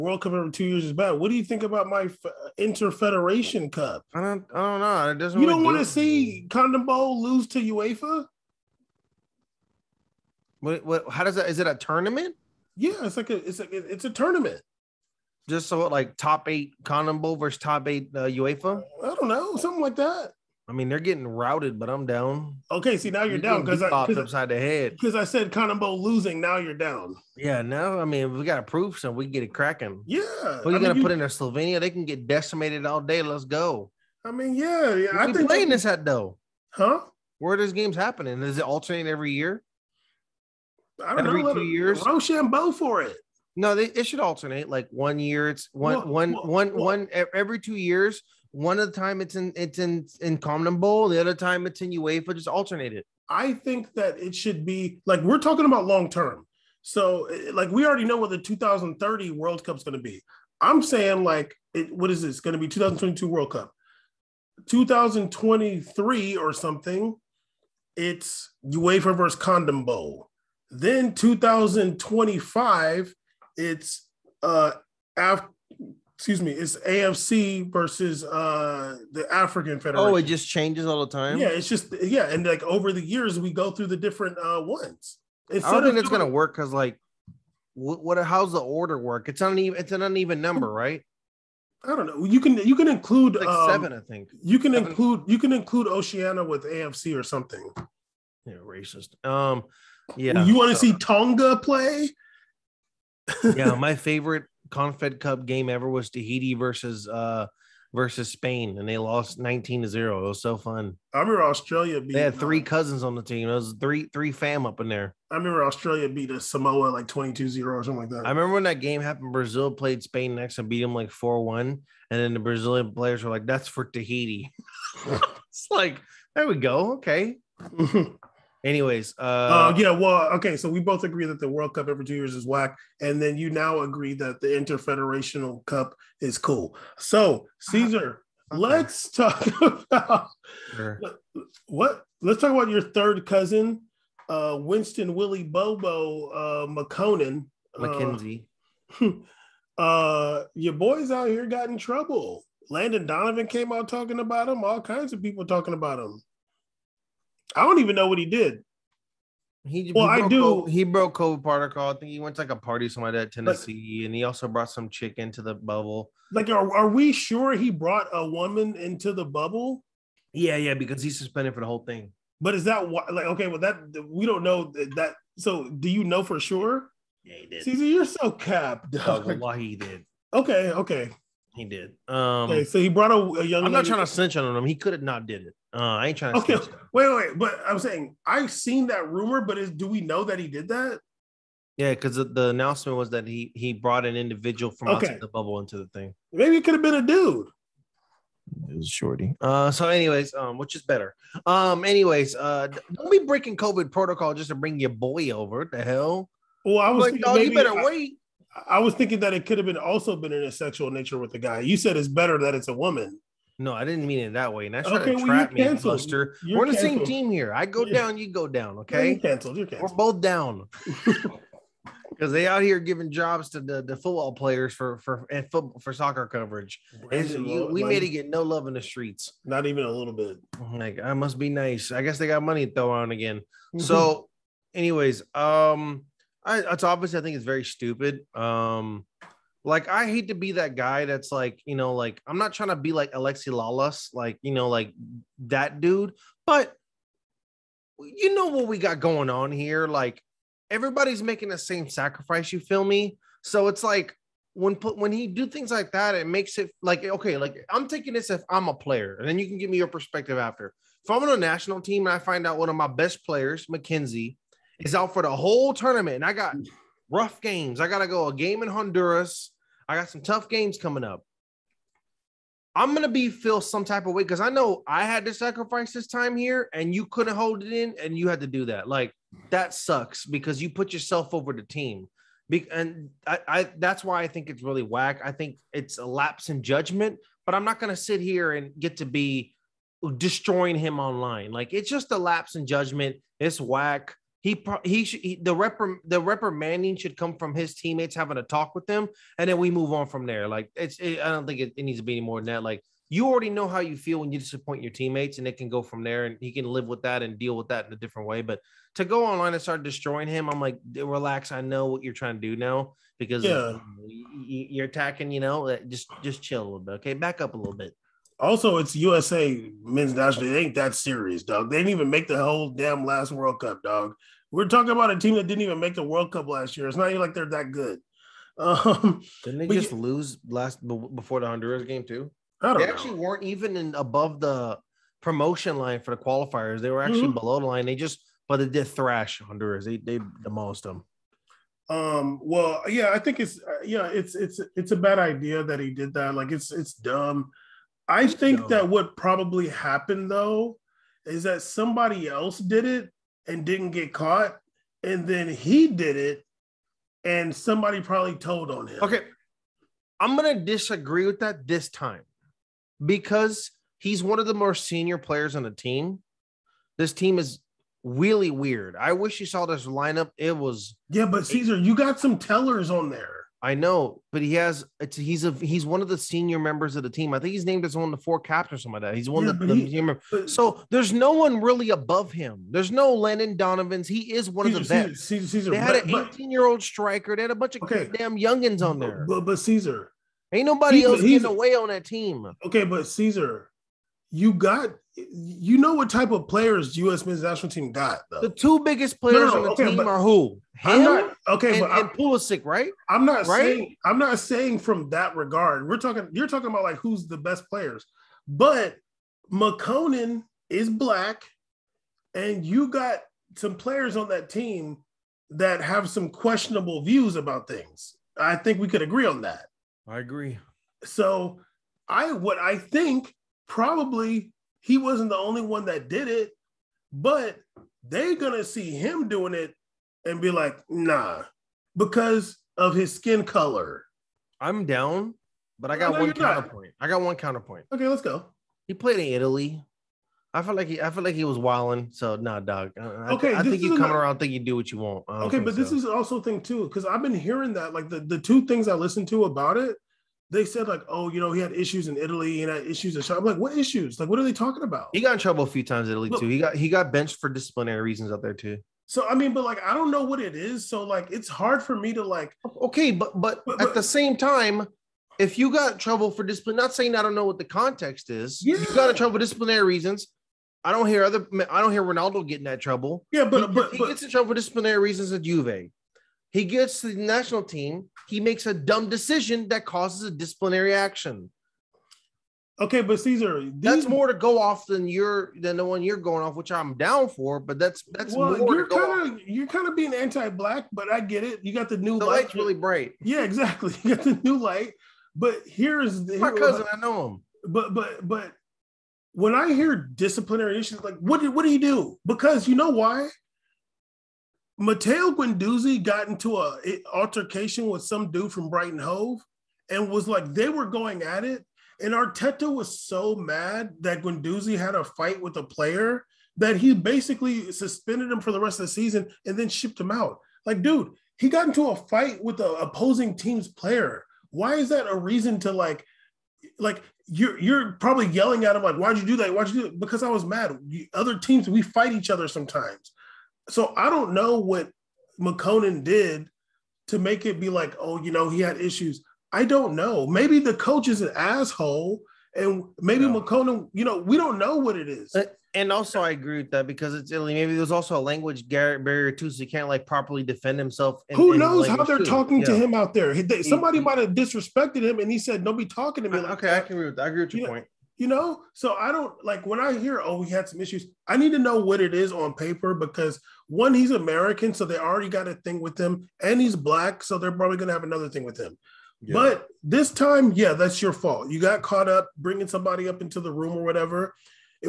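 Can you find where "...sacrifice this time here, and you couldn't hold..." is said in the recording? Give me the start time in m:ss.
4:35.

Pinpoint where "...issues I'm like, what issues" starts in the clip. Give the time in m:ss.
7:32.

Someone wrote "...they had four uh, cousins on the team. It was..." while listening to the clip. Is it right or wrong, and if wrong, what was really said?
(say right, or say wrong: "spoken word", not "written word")
wrong: "three", not "four".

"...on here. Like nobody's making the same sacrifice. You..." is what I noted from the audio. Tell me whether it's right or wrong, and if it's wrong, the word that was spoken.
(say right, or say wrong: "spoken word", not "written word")
wrong: "everybody", not "nobody".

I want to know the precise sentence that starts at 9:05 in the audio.
and also, I agree with that because it's Italy.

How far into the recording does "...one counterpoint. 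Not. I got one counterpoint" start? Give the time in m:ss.
7:16.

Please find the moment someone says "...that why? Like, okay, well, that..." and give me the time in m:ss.
2:52.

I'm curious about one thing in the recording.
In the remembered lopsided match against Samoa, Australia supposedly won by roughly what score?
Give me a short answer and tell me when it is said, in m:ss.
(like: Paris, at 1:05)
22-0, at 1:57.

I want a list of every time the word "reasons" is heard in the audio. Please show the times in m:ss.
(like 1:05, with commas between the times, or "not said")
7:38, 7:49, 7:54, 8:45.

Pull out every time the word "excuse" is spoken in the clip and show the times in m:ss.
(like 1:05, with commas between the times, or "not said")
1:16.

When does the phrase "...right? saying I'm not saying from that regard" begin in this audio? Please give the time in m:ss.
6:43.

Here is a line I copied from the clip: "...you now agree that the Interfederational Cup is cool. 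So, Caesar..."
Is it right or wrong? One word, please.
right.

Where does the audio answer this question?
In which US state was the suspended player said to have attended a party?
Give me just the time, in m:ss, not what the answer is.
2:43.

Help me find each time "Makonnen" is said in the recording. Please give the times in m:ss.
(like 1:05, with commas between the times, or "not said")
2:26, 6:49, 8:55, 9:03.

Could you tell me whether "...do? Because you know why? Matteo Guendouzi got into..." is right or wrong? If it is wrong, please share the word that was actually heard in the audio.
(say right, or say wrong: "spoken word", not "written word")
right.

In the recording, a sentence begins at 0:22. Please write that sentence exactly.
Okay, see now you're, down because I popped upside the head.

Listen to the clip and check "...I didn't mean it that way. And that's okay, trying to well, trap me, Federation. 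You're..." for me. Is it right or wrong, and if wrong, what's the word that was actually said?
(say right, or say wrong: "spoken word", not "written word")
wrong: "Buster", not "Federation".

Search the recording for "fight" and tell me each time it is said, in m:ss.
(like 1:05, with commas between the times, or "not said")
8:35, 8:41, 8:51.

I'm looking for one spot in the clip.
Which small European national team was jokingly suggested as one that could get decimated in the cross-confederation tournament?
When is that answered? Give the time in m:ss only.
0:31.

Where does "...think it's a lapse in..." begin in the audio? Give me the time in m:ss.
4:45.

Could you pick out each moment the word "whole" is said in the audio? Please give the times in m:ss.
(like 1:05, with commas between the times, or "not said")
2:51, 4:25, 5:22.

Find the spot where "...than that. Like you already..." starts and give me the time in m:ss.
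5:02.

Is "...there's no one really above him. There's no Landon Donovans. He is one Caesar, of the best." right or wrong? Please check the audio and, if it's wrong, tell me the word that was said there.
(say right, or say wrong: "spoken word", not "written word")
right.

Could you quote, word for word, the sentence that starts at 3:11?
Yeah, because the, the, announcement was that he he brought an individual from okay.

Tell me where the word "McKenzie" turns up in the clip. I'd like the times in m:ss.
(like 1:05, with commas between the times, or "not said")
2:27, 4:23.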